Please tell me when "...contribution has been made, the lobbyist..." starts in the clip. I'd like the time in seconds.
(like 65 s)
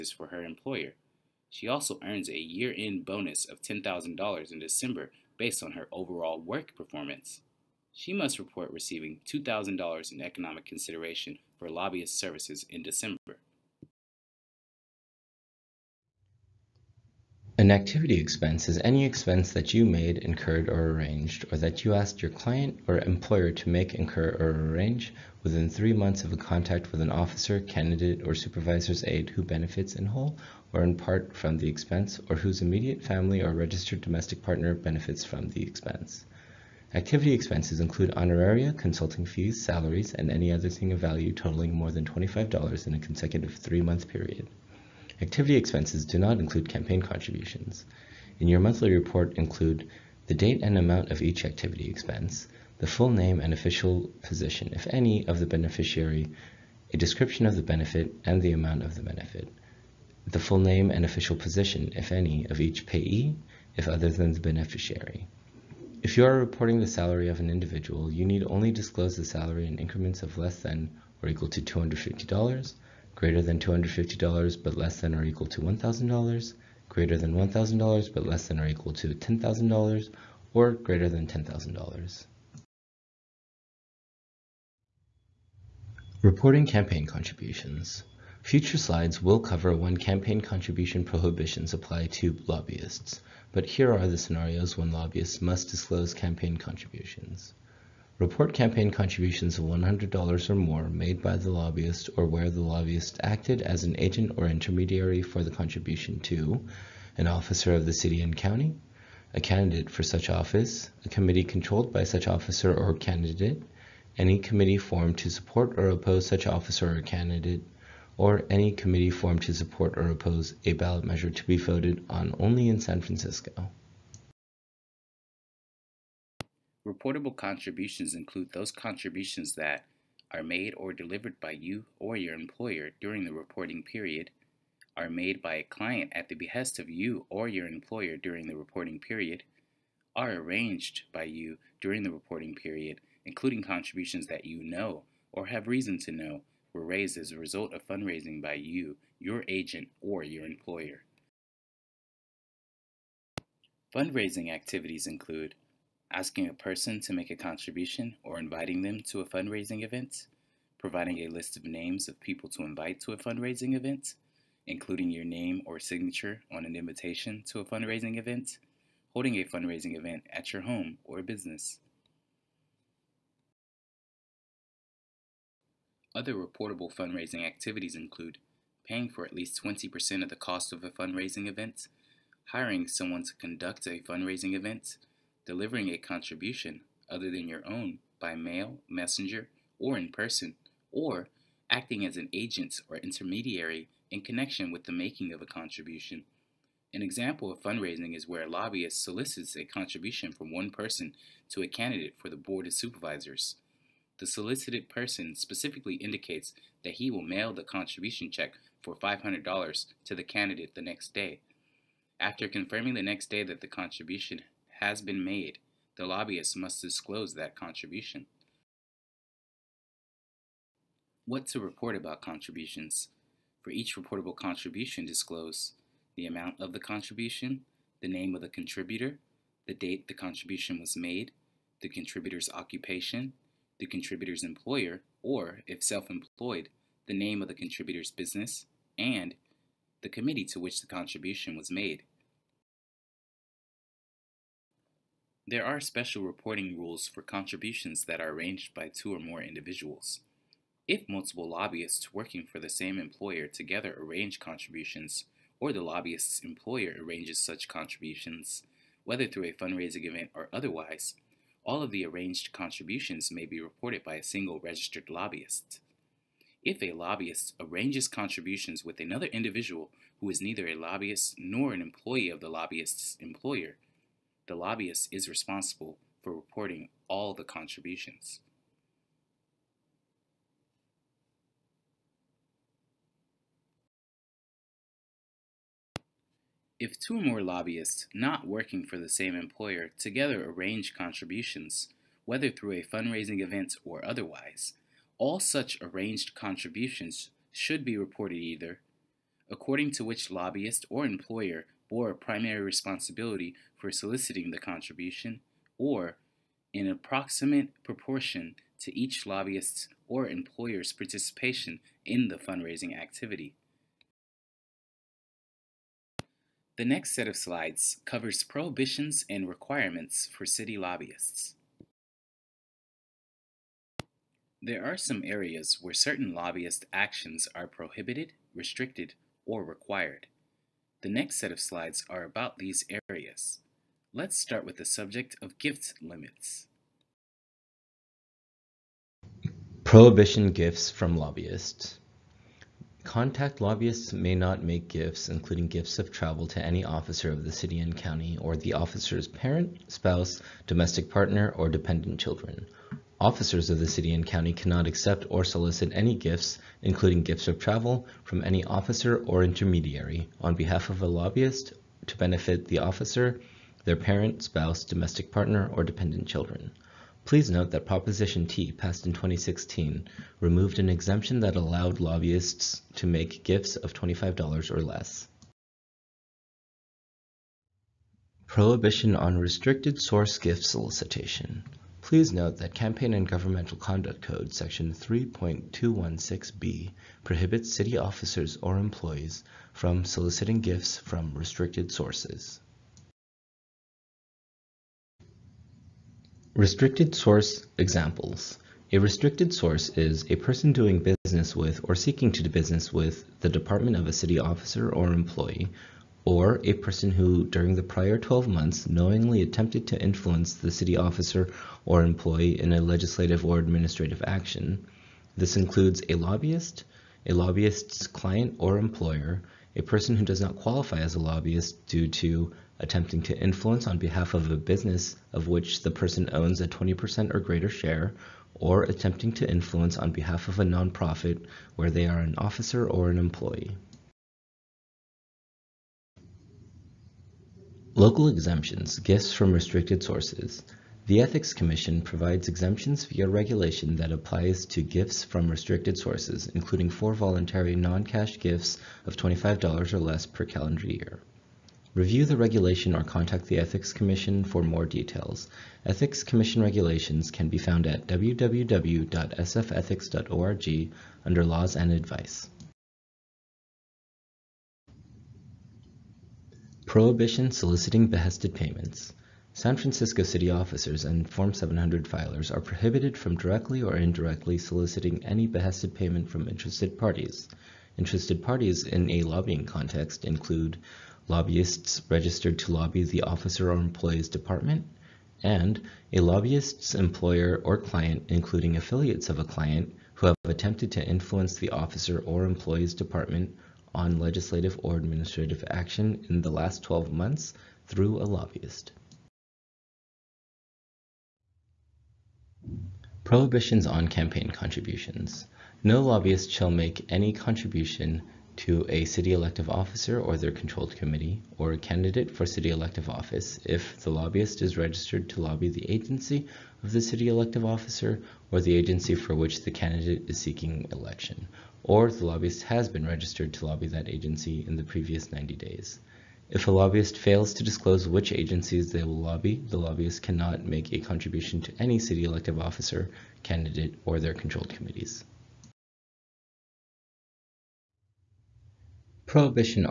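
213 s.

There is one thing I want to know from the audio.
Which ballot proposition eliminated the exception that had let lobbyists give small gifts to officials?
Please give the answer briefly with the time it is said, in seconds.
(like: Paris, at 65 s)
Proposition T, at 367 s.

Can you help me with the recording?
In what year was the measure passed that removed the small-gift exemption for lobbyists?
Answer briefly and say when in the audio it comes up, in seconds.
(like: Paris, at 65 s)
2016, at 369 s.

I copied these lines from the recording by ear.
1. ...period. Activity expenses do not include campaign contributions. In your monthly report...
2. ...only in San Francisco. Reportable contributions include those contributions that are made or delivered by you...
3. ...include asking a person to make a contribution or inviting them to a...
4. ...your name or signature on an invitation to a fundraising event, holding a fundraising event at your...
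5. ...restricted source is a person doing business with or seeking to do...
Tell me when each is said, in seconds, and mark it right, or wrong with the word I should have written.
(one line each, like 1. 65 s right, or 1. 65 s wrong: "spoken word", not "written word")
1. 44 s right
2. 122 s right
3. 155 s right
4. 165 s right
5. 398 s right.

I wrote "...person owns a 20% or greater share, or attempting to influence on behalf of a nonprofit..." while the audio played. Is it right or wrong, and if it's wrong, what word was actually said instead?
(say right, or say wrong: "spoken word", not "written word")
right.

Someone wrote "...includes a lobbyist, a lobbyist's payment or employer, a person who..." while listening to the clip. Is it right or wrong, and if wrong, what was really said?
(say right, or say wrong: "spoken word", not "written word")
wrong: "client", not "payment".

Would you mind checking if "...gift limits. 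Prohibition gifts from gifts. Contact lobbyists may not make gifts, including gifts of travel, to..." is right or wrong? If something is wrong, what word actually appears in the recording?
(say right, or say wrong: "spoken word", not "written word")
wrong: "lobbyists", not "gifts".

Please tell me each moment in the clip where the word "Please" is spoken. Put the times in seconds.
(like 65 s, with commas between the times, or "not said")
367 s, 381 s.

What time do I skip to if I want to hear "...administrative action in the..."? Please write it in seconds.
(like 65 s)
494 s.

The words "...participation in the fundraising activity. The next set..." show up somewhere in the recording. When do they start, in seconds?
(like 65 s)
310 s.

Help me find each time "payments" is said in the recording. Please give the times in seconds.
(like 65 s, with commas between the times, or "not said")
468 s, 475 s.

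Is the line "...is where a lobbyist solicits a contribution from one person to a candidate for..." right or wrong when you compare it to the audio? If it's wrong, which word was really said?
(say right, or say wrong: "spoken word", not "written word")
right.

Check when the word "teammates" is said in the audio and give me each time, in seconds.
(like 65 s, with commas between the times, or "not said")
not said.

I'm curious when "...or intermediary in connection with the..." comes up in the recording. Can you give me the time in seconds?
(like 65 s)
192 s.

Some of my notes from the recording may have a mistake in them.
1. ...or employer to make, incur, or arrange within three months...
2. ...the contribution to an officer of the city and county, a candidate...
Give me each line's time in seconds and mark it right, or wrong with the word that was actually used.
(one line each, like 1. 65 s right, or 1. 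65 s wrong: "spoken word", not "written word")
1. 22 s right
2. 105 s right.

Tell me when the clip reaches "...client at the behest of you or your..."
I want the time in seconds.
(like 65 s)
135 s.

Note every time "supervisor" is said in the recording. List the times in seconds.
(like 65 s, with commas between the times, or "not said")
28 s, 202 s.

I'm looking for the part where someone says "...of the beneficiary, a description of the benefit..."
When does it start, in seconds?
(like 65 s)
55 s.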